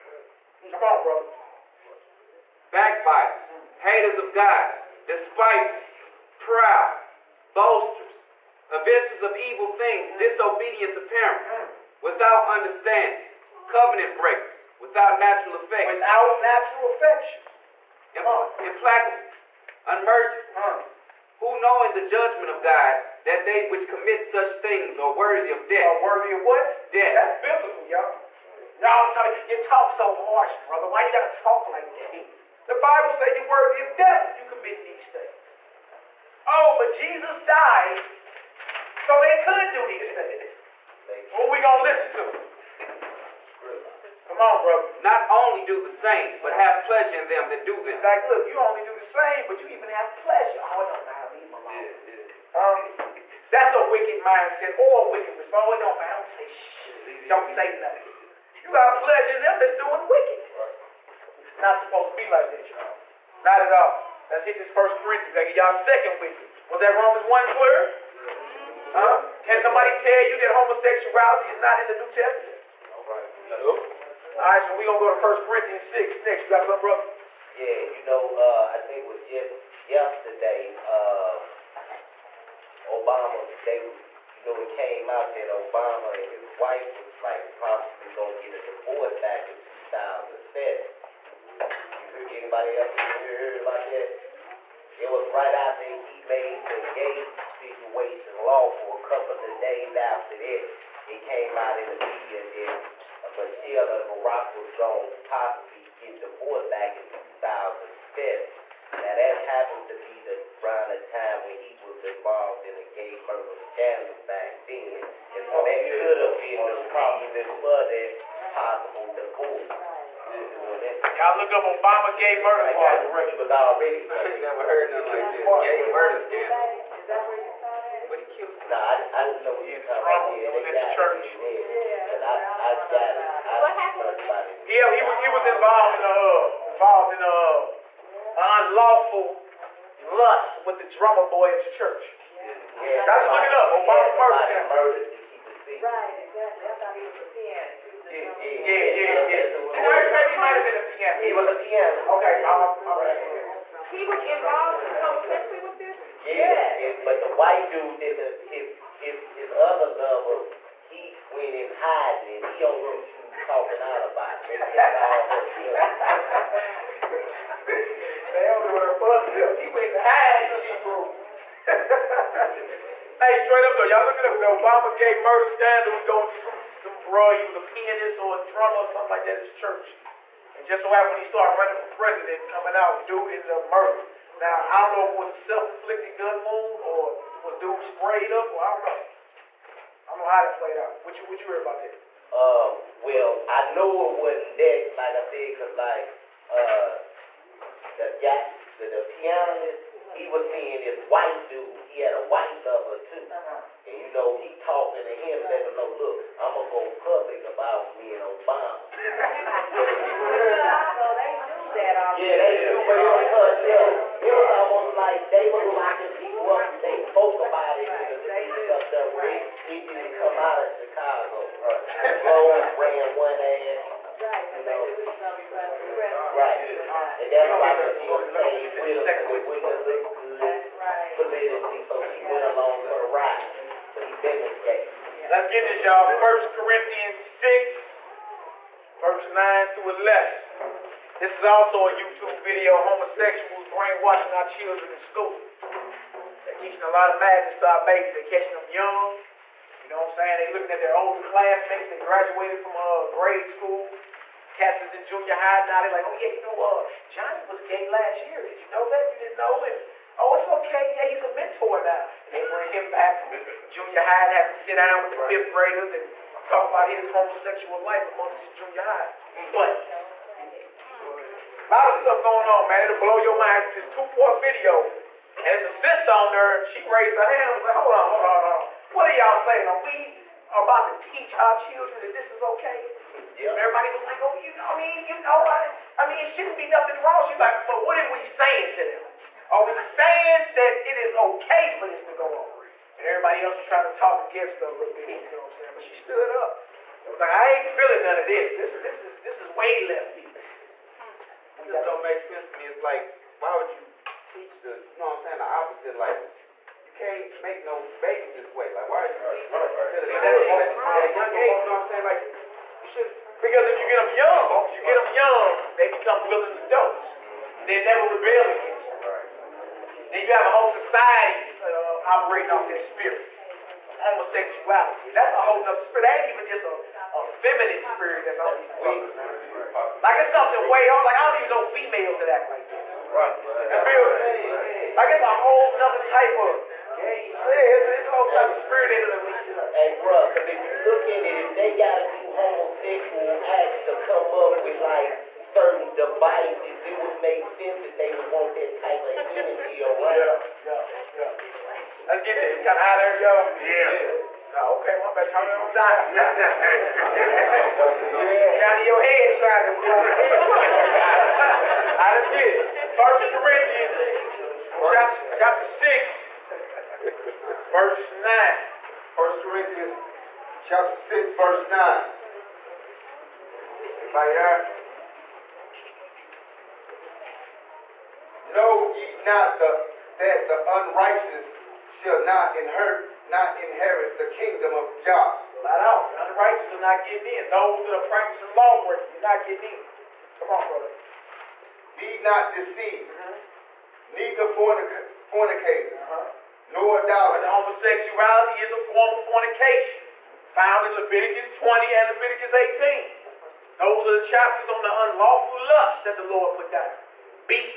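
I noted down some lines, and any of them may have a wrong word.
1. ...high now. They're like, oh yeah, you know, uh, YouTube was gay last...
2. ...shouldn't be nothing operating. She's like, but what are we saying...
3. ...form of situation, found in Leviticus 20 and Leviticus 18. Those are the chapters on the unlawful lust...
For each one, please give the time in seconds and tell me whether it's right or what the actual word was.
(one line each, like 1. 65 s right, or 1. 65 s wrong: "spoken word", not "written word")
1. 255 s wrong: "Johnny", not "YouTube"
2. 286 s wrong: "wrong", not "operating"
3. 398 s wrong: "fornication", not "situation".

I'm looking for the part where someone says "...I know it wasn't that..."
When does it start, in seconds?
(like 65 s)
193 s.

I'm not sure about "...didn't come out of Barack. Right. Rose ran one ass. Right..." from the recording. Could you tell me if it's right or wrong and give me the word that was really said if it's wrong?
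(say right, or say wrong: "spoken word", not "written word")
wrong: "Chicago", not "Barack".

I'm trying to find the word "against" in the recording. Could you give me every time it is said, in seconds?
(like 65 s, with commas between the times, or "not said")
294 s, 318 s.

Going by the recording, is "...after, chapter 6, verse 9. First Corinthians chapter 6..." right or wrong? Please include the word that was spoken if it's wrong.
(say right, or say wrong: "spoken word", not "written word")
wrong: "chapter", not "after".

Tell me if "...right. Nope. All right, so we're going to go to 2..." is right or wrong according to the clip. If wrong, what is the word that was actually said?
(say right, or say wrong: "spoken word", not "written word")
wrong: "1", not "2".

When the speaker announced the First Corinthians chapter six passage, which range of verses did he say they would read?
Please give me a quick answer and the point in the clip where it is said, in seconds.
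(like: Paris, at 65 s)
9 through 11, at 239 s.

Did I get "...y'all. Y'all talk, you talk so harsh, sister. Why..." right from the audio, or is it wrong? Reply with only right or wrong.
wrong.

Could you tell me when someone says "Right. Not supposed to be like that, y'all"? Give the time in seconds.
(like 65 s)
61 s.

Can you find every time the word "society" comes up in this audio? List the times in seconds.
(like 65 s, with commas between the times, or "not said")
320 s.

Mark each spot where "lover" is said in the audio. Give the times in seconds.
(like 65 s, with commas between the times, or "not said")
159 s, 202 s.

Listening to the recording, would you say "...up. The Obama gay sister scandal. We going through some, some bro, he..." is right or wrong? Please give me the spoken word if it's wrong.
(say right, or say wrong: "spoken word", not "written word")
wrong: "murder", not "sister".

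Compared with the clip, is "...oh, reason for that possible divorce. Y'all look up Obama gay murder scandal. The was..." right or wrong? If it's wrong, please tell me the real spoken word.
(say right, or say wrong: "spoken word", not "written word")
right.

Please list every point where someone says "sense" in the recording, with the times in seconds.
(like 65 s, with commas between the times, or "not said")
302 s, 347 s.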